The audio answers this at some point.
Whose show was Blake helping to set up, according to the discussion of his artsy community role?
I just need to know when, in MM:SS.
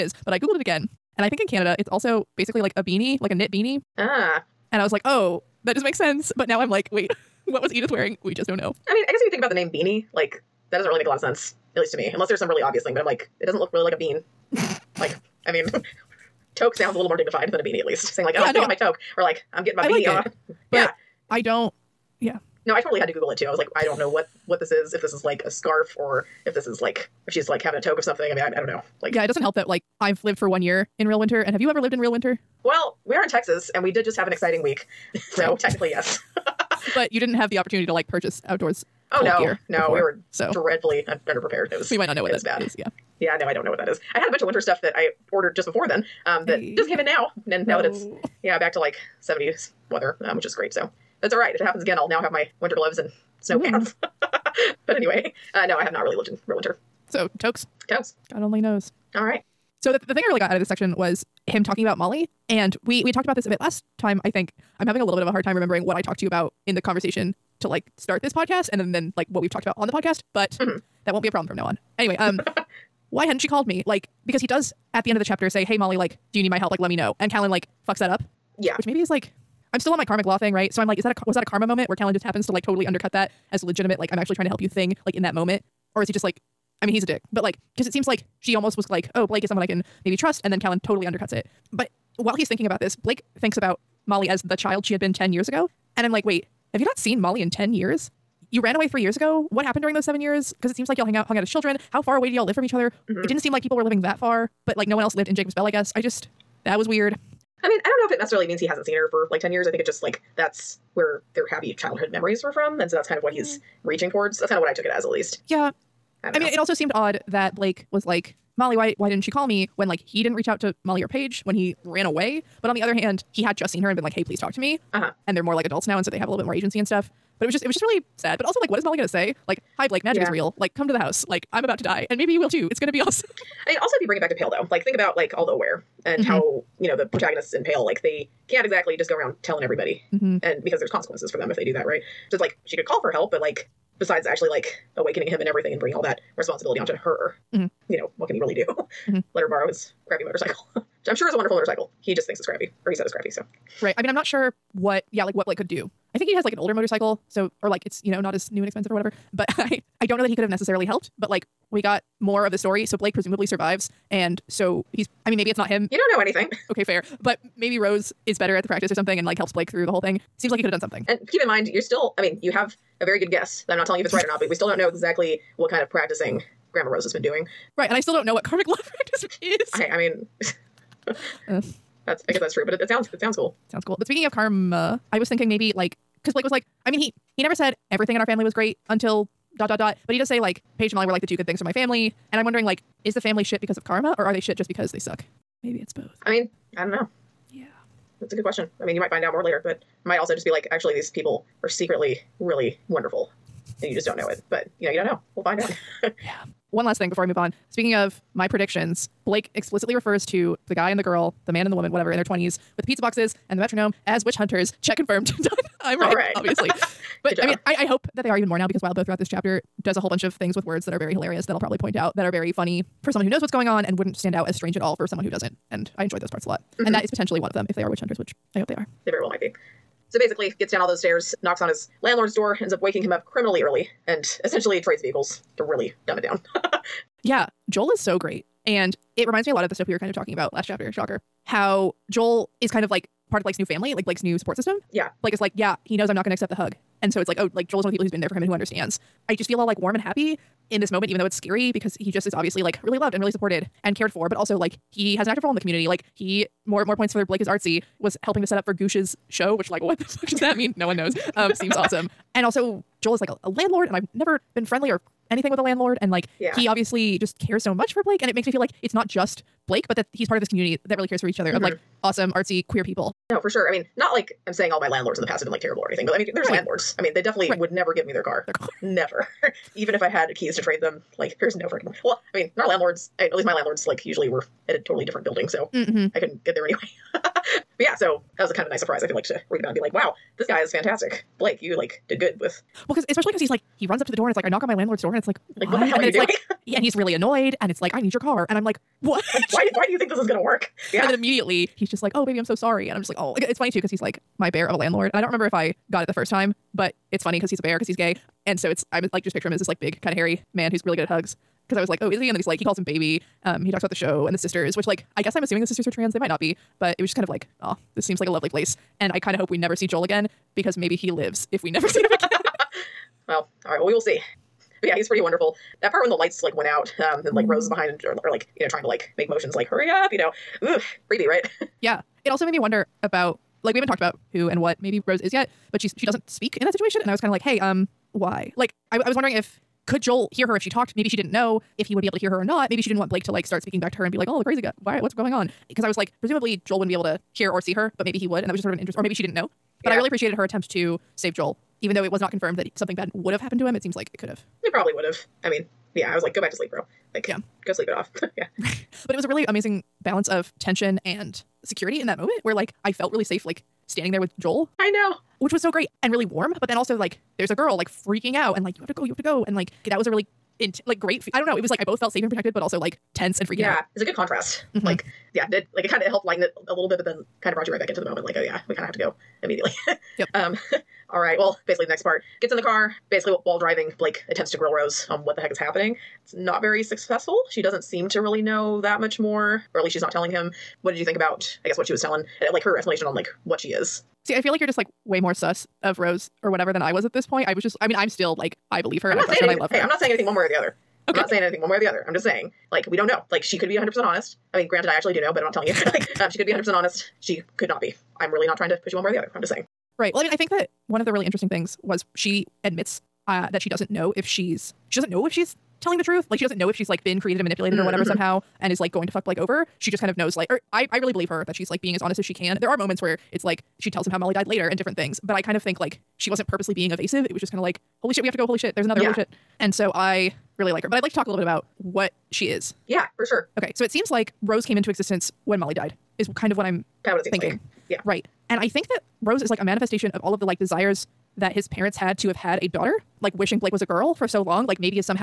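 04:18.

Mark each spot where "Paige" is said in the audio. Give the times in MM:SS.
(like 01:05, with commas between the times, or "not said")
02:01, 03:10.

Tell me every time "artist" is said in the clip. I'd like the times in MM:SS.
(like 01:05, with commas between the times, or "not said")
not said.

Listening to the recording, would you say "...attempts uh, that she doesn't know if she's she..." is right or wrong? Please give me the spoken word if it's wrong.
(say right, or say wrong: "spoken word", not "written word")
wrong: "admits", not "attempts".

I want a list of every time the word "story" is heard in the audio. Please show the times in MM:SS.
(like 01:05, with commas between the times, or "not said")
02:42.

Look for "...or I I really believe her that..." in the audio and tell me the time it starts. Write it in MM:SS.
07:00.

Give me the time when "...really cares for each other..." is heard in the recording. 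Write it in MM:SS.
04:30.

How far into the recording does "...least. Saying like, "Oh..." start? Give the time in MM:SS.
00:17.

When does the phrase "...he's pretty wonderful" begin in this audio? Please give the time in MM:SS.
05:24.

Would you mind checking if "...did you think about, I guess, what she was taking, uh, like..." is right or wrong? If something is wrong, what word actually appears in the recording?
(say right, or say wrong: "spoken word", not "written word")
wrong: "telling", not "taking".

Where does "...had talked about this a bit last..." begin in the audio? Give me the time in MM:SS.
01:03.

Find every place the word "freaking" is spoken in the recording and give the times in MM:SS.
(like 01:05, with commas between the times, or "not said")
04:41, 06:07, 06:13.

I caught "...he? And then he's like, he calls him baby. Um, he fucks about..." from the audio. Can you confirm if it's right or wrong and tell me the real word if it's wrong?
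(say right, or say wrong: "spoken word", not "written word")
wrong: "talks", not "fucks".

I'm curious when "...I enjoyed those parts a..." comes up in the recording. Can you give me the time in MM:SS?
03:45.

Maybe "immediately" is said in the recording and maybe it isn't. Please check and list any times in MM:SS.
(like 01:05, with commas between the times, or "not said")
05:01, 06:19.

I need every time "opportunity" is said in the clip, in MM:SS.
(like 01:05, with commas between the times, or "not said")
00:37.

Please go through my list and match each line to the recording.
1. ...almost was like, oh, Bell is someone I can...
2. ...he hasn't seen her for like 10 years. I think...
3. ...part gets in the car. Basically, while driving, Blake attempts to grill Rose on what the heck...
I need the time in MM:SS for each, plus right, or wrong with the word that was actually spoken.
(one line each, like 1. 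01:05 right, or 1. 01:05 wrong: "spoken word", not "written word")
1. 01:28 wrong: "Blake", not "Bell"
2. 01:48 right
3. 06:22 right.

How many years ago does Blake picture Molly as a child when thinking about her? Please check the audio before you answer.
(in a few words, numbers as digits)
10.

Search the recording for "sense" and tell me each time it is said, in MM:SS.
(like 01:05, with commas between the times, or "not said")
00:05, 00:11.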